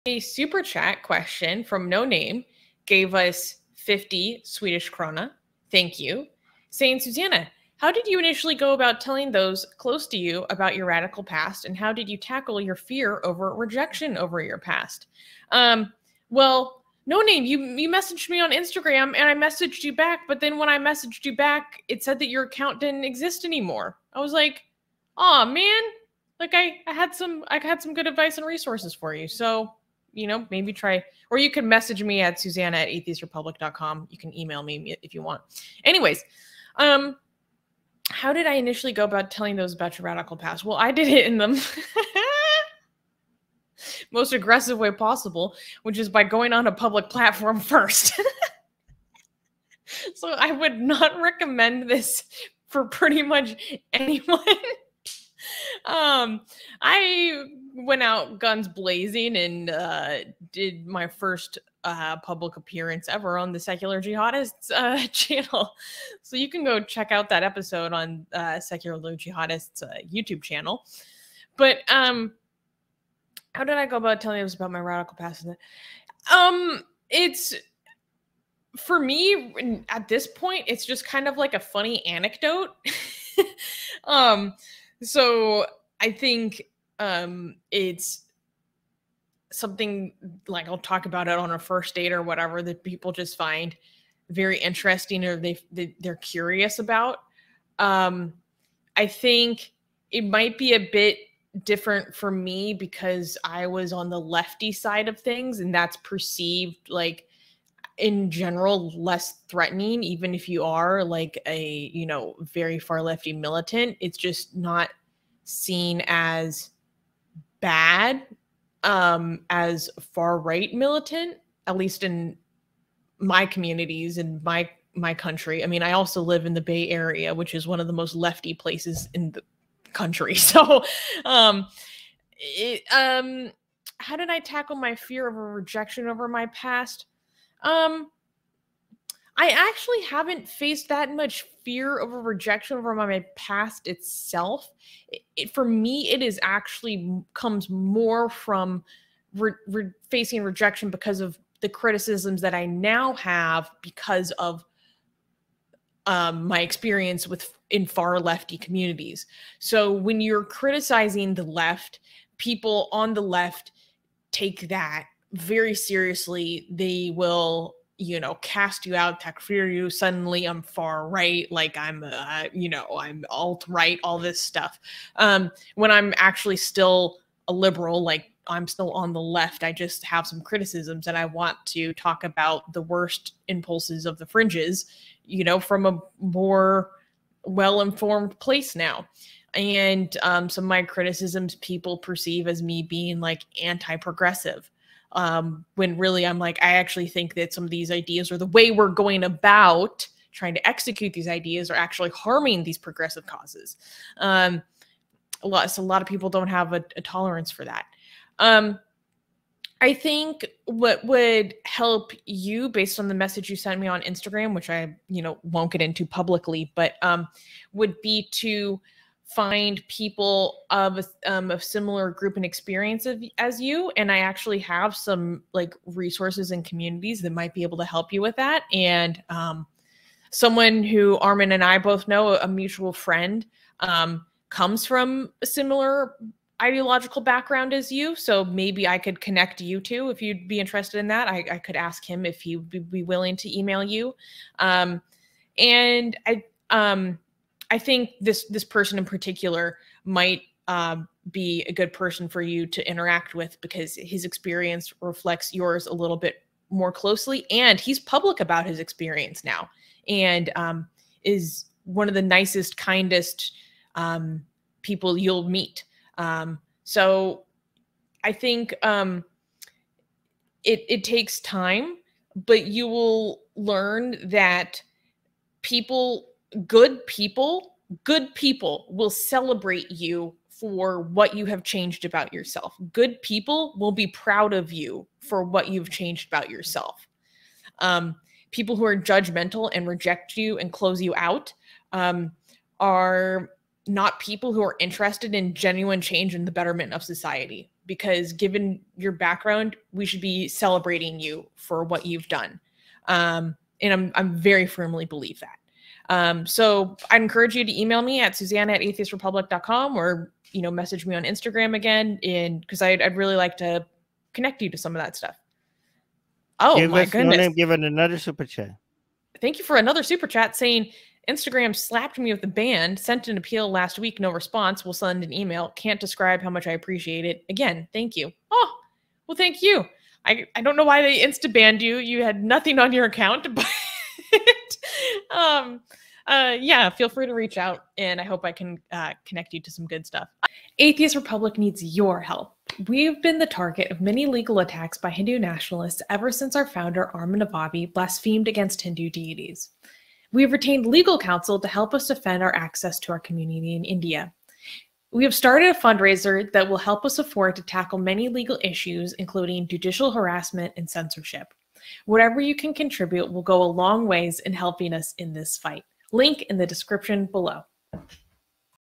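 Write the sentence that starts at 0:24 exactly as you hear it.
I was like, oh man, like I, I had some I had some good advice and resources for you.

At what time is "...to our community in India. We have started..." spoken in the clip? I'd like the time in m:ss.
5:53.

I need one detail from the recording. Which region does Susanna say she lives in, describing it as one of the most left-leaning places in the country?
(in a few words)
Bay Area.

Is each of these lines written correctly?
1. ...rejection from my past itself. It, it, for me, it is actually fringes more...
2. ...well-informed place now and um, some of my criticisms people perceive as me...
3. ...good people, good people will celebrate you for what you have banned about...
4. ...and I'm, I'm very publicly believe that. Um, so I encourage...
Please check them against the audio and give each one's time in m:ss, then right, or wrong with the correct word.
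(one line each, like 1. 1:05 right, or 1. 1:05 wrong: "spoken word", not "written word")
1. 2:22 wrong: "comes", not "fringes"
2. 3:07 right
3. 4:36 wrong: "changed", not "banned"
4. 5:03 wrong: "firmly", not "publicly".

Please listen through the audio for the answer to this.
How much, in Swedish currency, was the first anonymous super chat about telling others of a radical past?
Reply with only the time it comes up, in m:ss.
0:03.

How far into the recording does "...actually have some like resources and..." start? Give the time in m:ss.
3:44.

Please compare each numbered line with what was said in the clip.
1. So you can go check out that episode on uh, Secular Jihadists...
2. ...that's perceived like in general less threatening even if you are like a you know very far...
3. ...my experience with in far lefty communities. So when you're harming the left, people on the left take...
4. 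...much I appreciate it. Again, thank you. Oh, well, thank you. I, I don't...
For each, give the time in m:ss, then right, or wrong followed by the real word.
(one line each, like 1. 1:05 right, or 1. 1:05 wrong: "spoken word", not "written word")
1. 1:06 right
2. 1:45 right
3. 2:36 wrong: "criticizing", not "harming"
4. 5:26 right.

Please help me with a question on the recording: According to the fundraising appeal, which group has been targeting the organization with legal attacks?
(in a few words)
Hindu nationalists.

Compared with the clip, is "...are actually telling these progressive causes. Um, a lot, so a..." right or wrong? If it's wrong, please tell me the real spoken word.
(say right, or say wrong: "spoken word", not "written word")
wrong: "harming", not "telling".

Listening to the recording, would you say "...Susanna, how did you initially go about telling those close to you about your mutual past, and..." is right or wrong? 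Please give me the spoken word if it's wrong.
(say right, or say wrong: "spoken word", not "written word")
wrong: "radical", not "mutual".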